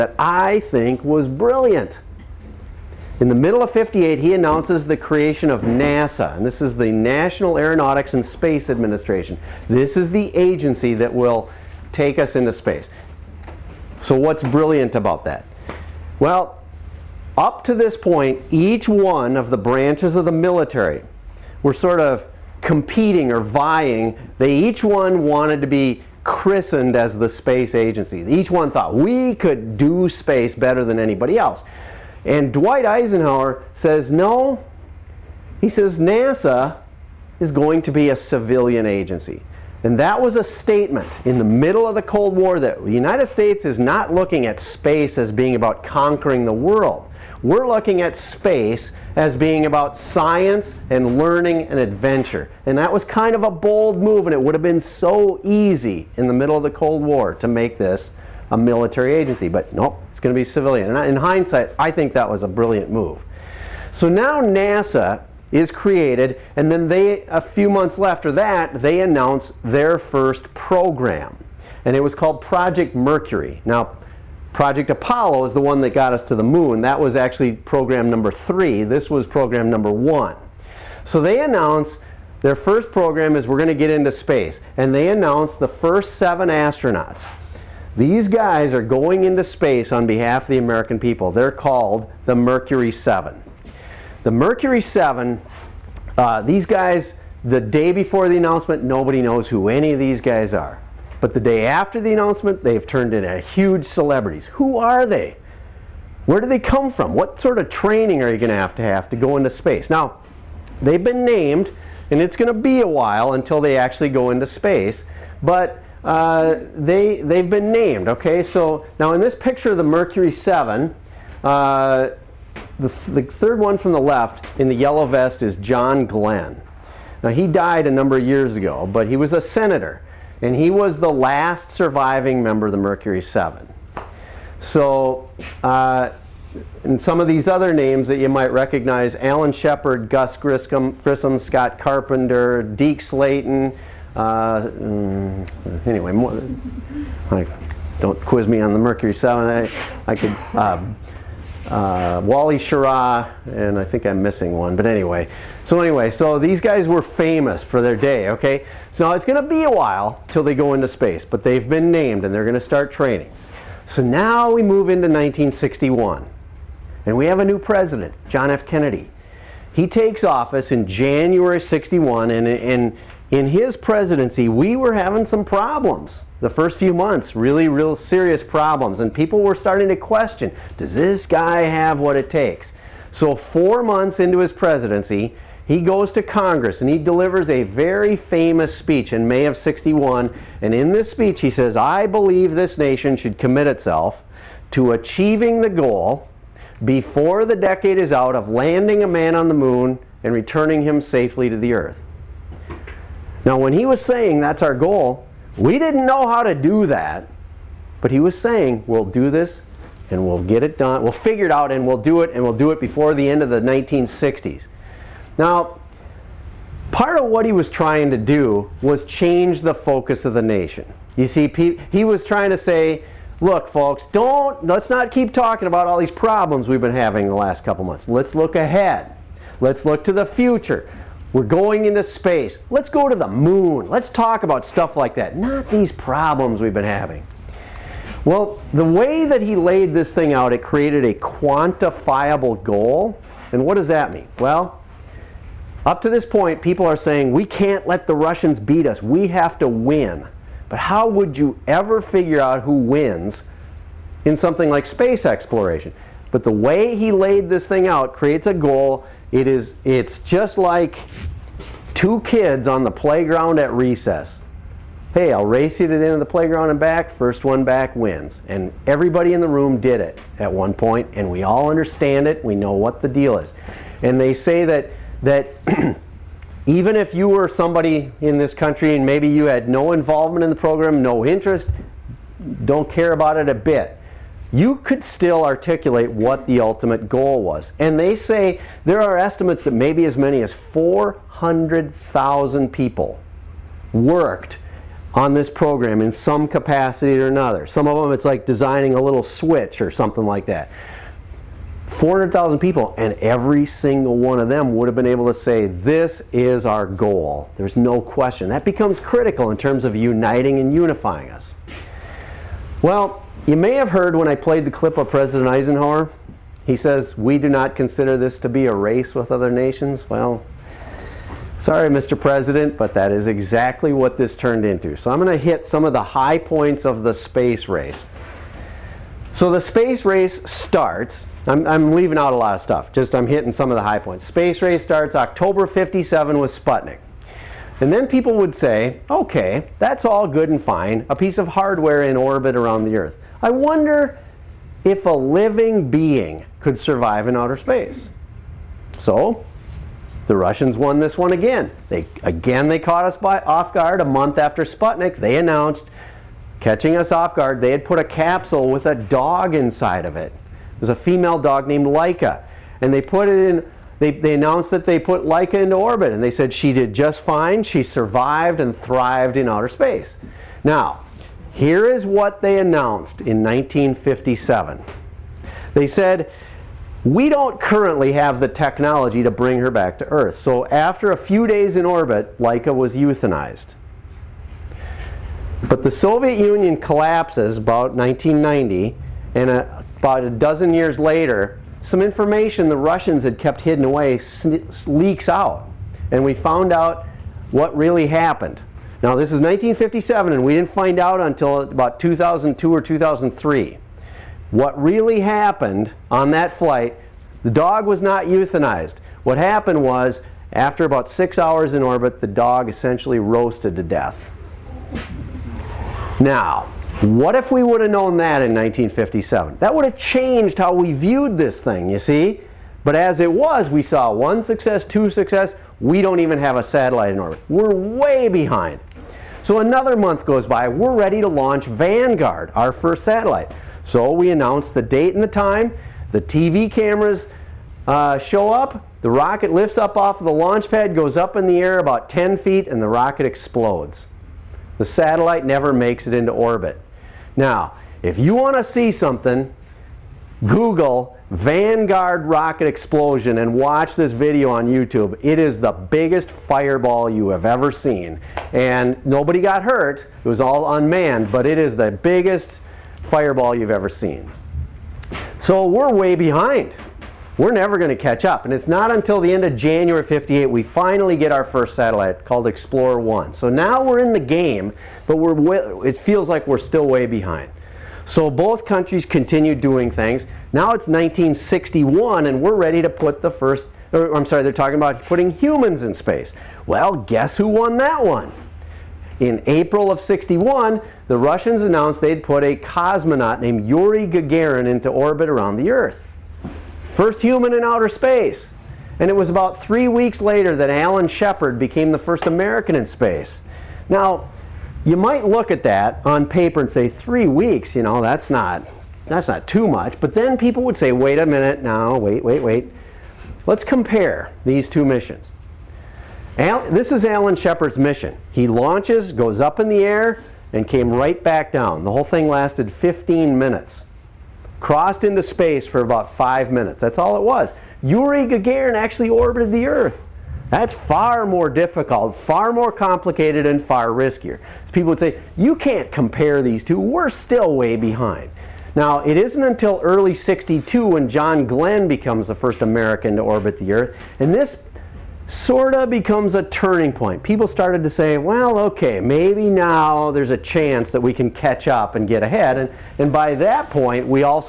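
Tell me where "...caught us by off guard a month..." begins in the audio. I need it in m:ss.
5:52.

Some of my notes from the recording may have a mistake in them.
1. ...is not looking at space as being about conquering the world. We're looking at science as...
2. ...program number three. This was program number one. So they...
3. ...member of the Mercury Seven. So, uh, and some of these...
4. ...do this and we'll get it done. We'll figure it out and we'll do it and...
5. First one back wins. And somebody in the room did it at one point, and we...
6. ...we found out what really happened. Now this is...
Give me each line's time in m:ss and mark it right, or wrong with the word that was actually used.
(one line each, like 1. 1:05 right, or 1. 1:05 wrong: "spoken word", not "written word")
1. 0:43 wrong: "space", not "science"
2. 1:17 right
3. 2:12 right
4. 3:29 right
5. 4:27 wrong: "everybody", not "somebody"
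6. 6:36 right.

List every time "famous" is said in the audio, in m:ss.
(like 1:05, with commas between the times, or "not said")
2:37, 3:08.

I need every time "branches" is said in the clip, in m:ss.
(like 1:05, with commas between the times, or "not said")
0:19.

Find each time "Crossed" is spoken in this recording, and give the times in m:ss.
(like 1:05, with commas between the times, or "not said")
8:44.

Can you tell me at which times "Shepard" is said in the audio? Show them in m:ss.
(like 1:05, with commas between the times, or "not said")
2:19, 8:21, 8:37.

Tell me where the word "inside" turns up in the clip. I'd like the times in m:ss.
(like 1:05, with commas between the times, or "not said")
5:59.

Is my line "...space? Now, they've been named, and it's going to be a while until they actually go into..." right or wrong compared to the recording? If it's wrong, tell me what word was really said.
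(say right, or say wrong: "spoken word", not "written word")
right.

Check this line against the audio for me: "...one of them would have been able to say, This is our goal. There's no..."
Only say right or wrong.
right.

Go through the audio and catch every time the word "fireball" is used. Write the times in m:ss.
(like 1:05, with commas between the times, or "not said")
7:36, 7:42.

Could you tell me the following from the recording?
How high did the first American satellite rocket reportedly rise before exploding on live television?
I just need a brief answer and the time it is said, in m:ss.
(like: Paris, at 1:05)
10 feet, at 7:22.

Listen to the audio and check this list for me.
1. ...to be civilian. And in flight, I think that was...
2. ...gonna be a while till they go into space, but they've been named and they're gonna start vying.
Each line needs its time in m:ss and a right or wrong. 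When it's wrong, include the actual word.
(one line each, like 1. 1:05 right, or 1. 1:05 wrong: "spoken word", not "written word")
1. 1:00 wrong: "hindsight", not "flight"
2. 2:39 wrong: "training", not "vying".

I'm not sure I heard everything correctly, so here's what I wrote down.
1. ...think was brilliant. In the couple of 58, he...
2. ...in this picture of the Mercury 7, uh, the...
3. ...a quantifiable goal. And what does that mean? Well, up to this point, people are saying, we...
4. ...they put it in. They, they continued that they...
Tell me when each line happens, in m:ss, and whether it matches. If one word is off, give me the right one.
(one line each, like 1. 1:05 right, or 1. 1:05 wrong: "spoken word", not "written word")
1. 0:00 wrong: "middle", not "couple"
2. 1:59 right
3. 4:01 right
4. 6:02 wrong: "announced", not "continued".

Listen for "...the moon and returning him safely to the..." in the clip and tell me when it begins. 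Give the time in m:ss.
3:19.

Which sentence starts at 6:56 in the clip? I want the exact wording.
Now, what if we would have known that in 1957?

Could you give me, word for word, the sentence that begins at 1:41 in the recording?
But the day after the announcement, they've turned into huge celebrities.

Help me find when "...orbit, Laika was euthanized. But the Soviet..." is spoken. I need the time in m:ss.
6:21.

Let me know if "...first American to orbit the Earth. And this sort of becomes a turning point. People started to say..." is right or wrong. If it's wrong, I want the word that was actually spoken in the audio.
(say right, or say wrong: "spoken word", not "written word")
right.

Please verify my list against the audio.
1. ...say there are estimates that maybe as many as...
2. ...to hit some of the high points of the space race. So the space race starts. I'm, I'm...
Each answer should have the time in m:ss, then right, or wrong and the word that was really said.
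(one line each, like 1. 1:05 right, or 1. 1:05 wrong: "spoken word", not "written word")
1. 4:48 right
2. 5:25 right.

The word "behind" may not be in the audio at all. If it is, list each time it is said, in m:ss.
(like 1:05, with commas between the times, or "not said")
7:08, 7:46, 7:57, 8:57.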